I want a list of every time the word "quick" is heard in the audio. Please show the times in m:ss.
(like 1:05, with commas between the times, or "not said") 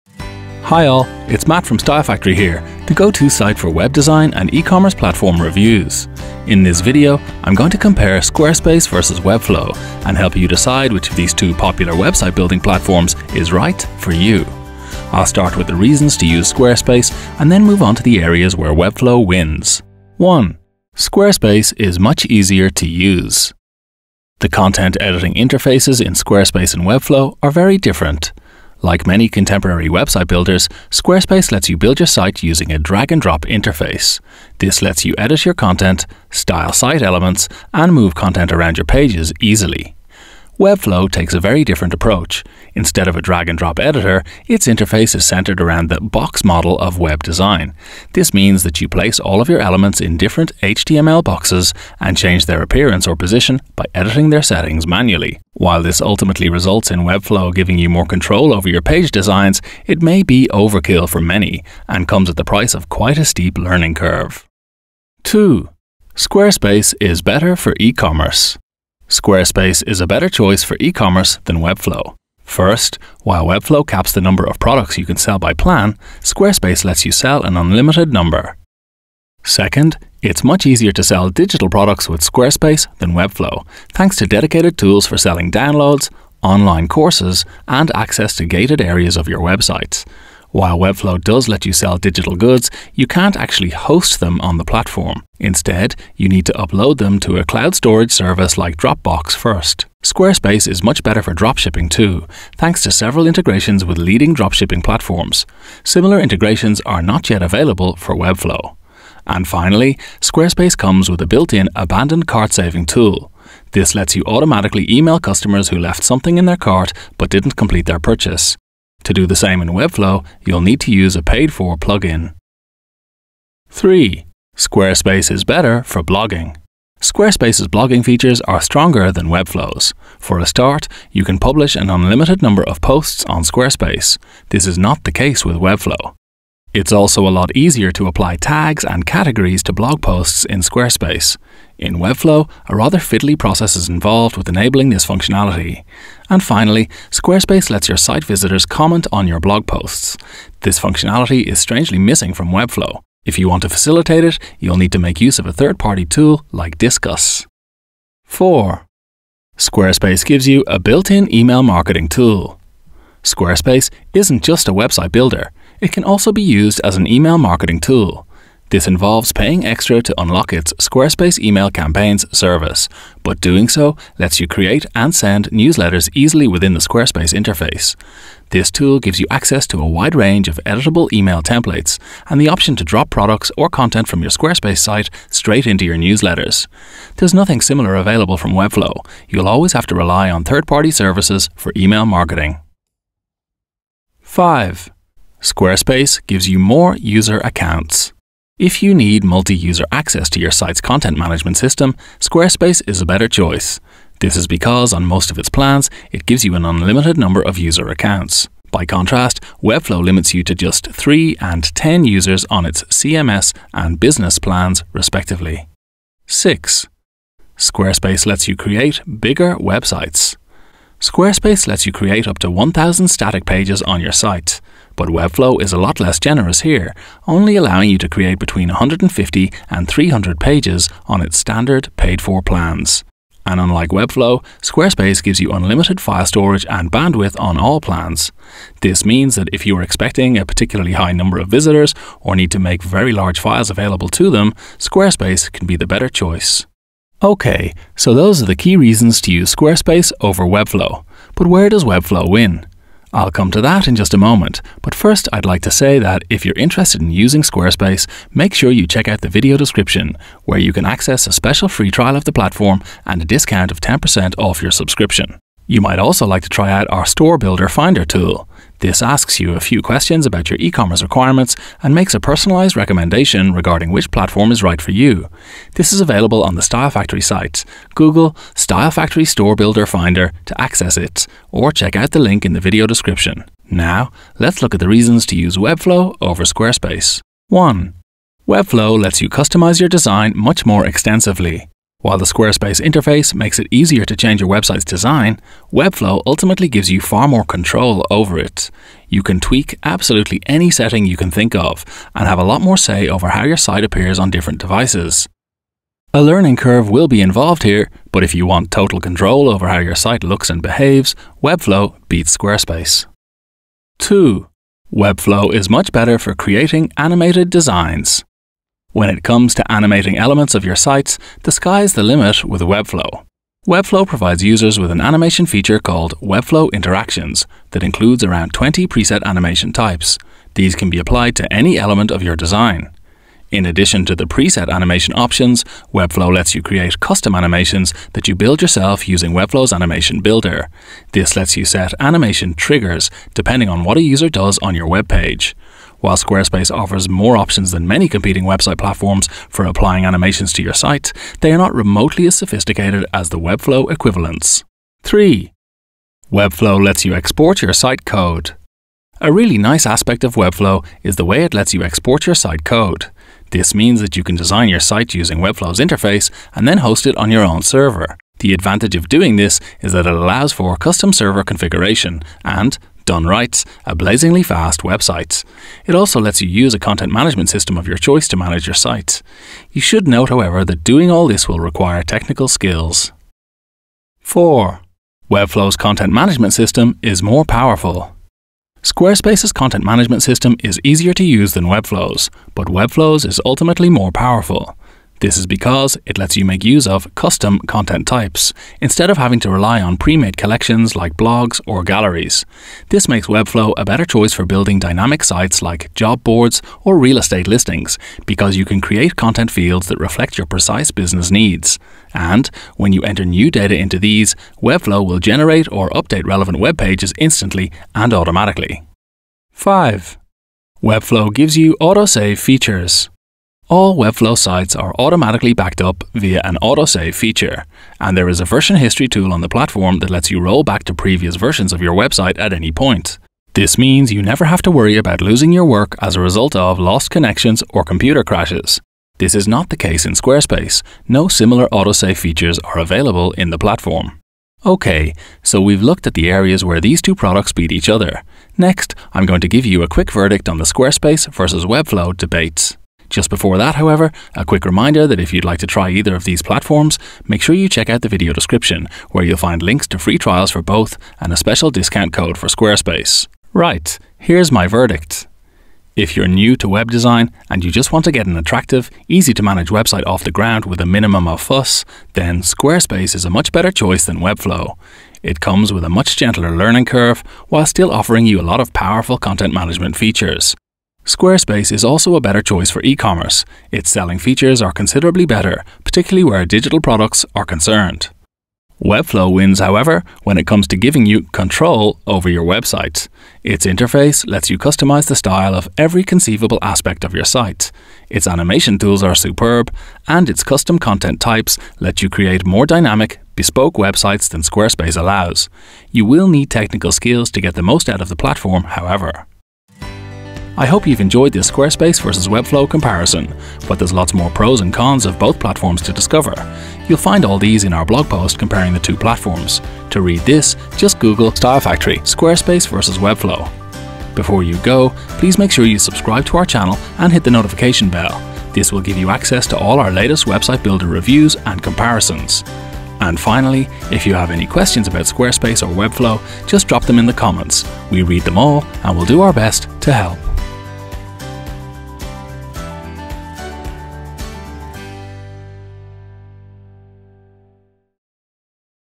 7:29, 7:34.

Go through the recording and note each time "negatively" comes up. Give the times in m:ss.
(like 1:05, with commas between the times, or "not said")
not said.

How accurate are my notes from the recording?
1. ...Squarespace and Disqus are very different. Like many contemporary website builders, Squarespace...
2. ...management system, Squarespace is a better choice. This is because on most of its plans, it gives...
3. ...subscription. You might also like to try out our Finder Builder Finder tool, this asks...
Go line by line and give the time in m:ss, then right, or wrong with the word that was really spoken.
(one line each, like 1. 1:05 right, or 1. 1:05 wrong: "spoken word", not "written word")
1. 0:26 wrong: "Webflow", not "Disqus"
2. 3:21 right
3. 4:24 wrong: "Store", not "Finder".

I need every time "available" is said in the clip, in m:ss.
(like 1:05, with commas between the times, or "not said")
1:47, 3:07, 4:03, 4:36, 7:22.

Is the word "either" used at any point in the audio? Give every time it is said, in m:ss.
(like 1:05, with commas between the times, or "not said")
7:35.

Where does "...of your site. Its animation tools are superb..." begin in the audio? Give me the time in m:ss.
8:17.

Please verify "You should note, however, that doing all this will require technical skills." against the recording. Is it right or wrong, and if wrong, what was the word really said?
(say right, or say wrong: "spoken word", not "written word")
right.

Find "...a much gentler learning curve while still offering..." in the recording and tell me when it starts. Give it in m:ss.
7:55.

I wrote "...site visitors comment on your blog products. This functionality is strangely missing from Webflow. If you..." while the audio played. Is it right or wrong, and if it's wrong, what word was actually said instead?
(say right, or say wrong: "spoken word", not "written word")
wrong: "posts", not "products".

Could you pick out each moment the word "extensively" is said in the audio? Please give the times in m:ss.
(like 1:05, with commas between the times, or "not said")
4:50.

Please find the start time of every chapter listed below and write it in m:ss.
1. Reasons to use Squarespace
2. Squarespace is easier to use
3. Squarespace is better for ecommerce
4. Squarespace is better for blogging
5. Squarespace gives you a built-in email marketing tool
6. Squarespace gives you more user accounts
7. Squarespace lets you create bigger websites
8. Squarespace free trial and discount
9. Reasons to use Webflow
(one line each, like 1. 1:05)
1. 0:11
2. 0:22
3. 1:06
4. 2:05
5. 2:39
6. 3:15
7. 3:37
8. 4:14
9. 4:41.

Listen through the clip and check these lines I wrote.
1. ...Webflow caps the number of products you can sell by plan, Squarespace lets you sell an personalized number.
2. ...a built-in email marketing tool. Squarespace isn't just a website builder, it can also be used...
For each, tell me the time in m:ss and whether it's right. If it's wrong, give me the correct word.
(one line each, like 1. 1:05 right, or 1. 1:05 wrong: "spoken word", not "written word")
1. 1:13 wrong: "unlimited", not "personalized"
2. 2:40 right.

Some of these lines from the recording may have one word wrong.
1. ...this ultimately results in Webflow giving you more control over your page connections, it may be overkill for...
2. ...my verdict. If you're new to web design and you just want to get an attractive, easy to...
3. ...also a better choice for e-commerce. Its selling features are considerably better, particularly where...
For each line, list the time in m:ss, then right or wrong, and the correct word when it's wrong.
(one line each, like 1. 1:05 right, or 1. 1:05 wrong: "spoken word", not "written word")
1. 0:55 wrong: "designs", not "connections"
2. 7:44 right
3. 8:01 right.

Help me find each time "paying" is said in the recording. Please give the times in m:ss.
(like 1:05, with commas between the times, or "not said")
2:49.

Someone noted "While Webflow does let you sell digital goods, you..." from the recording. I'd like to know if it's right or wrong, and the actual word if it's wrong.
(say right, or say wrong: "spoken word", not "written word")
right.